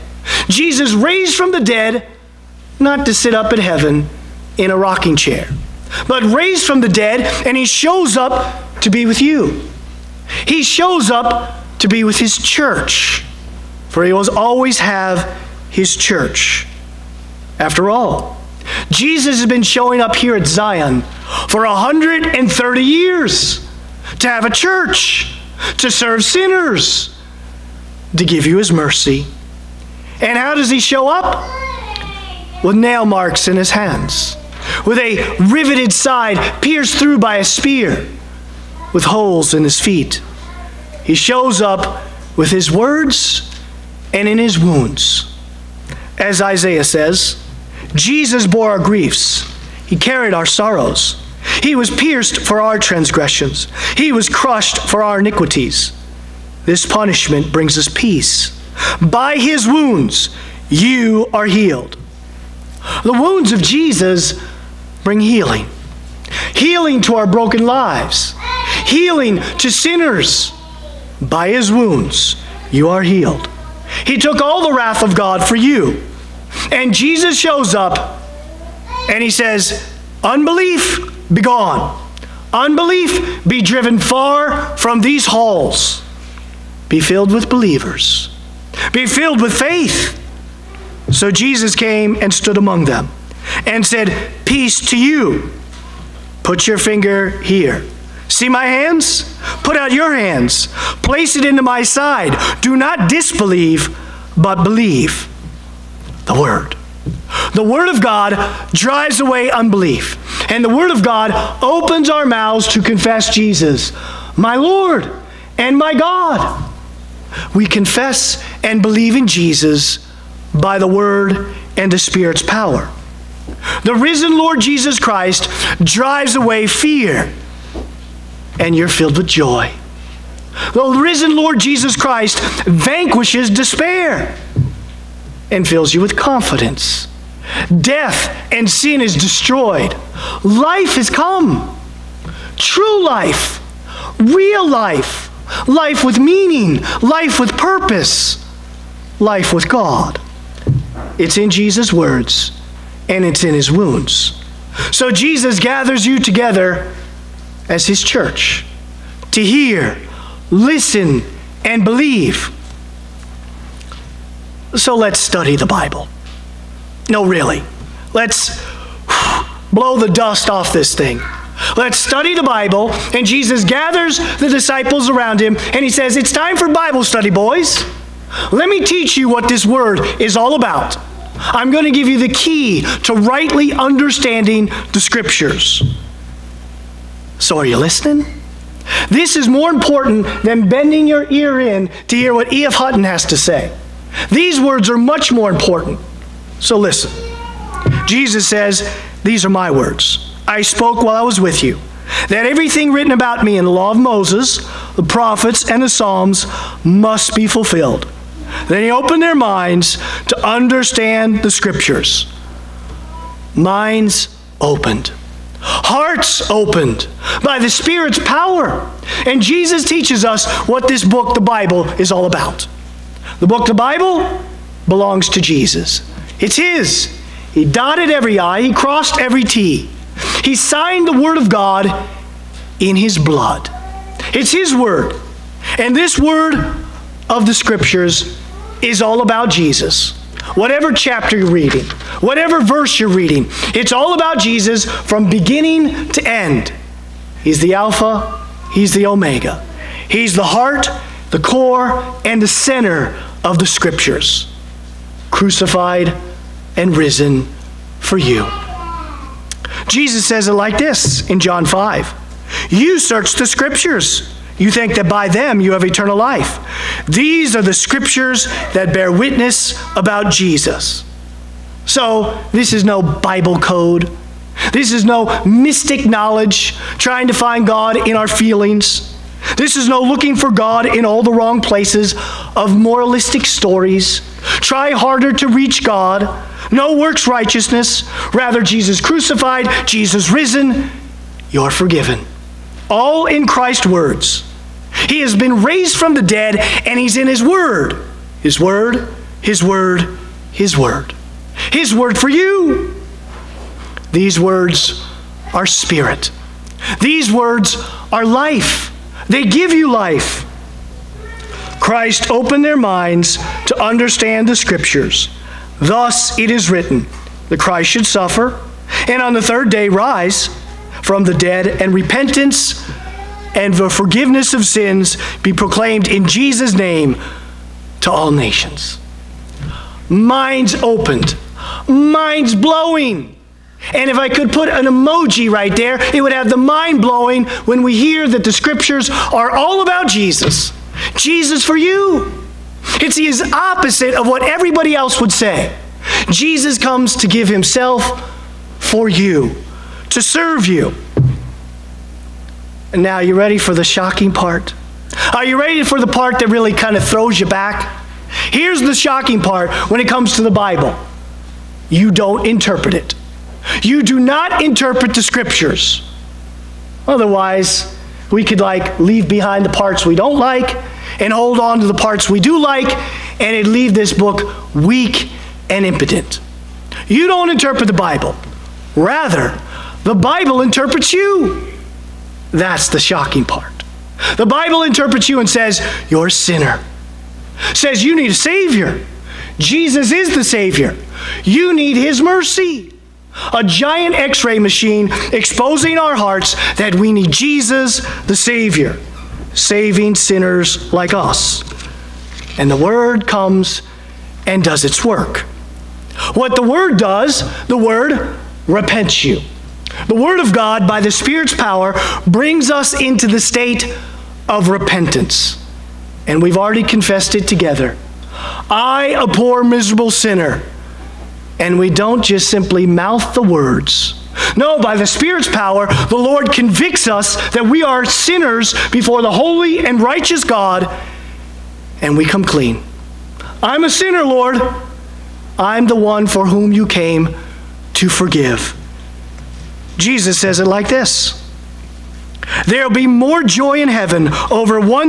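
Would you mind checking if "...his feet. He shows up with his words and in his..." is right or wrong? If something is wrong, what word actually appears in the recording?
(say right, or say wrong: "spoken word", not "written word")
right.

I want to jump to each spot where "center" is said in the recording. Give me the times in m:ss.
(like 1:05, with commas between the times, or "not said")
4:12.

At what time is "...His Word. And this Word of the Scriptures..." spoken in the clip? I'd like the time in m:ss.
3:54.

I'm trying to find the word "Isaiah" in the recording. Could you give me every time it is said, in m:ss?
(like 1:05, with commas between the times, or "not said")
0:46.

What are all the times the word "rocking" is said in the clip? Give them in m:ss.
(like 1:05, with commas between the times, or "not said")
0:04.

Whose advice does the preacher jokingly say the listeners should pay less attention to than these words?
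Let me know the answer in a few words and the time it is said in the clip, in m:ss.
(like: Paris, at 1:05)
E.F. Hutton, at 3:12.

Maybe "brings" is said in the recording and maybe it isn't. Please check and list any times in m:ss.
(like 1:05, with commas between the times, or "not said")
0:57, 1:05, 6:52.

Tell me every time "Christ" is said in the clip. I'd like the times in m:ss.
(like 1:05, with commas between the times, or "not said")
2:04, 2:11, 4:53, 5:11, 5:17.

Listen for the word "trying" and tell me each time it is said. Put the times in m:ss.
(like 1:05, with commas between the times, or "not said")
4:36.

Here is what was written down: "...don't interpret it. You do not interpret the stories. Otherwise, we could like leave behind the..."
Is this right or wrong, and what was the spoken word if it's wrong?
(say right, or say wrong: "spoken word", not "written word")
wrong: "scriptures", not "stories".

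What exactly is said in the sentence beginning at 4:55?
He has been raised from the dead and he's in his word.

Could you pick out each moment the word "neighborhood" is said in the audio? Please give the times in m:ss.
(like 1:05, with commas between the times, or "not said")
not said.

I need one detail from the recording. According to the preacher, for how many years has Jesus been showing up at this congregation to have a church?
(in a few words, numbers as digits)
130.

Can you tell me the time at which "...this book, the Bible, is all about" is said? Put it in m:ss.
3:40.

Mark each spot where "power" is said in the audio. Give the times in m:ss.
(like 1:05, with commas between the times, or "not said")
2:02, 3:38, 6:51, 7:05.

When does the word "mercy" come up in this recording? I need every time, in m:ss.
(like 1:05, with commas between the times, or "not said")
0:28, 6:32.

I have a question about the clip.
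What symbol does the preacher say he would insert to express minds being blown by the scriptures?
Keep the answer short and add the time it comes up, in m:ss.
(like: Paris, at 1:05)
An emoji, at 5:34.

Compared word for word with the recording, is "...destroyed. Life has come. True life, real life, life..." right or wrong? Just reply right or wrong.
right.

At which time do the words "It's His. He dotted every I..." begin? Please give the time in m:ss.
3:46.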